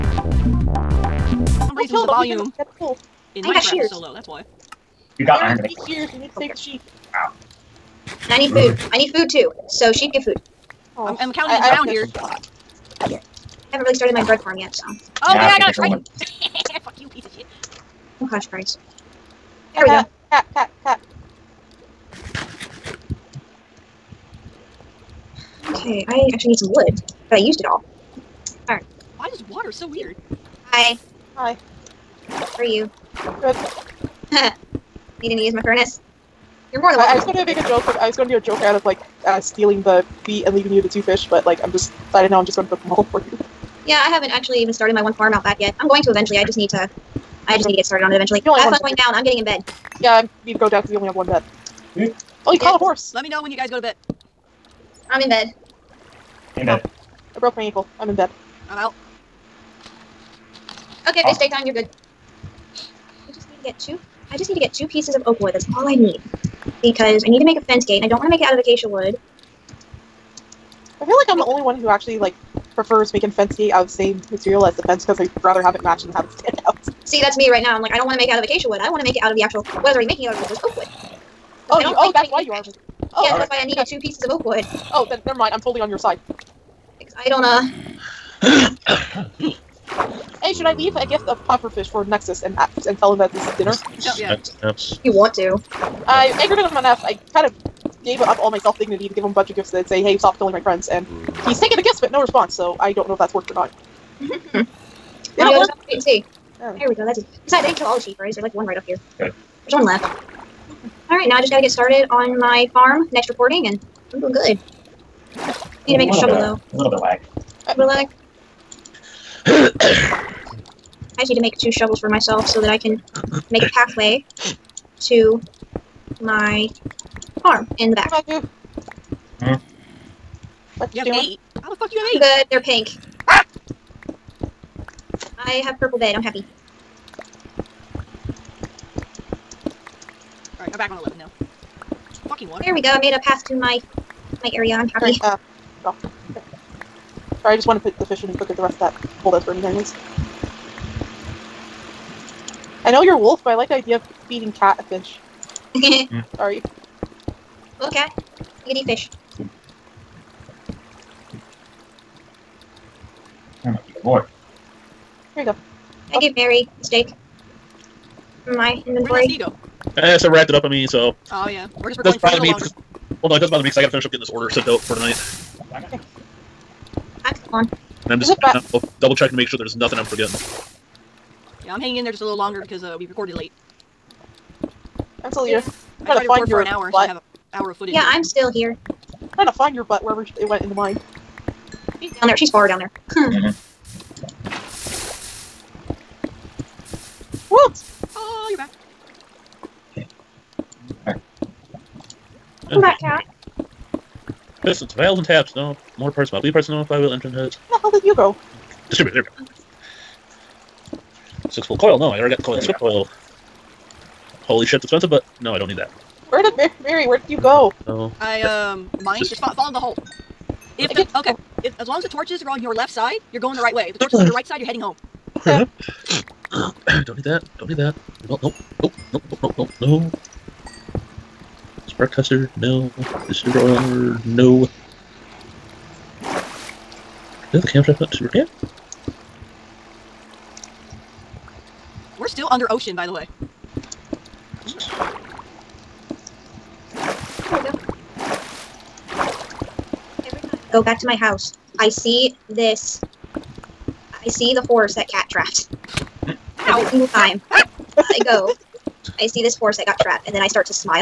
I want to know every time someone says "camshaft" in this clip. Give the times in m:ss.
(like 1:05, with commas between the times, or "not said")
3:57.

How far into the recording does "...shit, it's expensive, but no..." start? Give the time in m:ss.
3:34.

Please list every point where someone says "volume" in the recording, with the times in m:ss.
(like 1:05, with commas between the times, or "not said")
0:02.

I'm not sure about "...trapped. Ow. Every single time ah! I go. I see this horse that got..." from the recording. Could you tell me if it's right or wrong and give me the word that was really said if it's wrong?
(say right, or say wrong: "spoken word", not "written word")
right.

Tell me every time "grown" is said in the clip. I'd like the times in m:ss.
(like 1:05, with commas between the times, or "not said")
not said.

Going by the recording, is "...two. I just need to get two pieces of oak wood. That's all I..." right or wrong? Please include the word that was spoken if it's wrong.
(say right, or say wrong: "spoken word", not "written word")
right.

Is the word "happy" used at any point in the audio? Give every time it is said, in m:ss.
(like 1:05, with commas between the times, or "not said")
2:16, 2:24.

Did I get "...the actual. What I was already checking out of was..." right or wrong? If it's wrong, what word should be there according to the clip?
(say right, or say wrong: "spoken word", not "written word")
wrong: "making", not "checking".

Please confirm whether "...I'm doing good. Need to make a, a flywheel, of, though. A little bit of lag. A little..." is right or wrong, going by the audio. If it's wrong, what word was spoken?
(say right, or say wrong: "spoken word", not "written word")
wrong: "shovel", not "flywheel".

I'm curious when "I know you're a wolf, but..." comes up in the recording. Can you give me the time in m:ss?
2:32.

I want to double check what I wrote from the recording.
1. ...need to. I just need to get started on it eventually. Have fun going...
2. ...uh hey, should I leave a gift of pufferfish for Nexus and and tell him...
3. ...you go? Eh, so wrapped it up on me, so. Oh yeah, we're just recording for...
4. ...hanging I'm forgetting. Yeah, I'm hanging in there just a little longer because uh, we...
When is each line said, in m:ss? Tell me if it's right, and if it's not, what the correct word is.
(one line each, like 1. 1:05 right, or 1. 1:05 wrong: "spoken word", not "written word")
1. 0:46 right
2. 1:27 right
3. 2:49 right
4. 2:59 wrong: "nothing", not "hanging".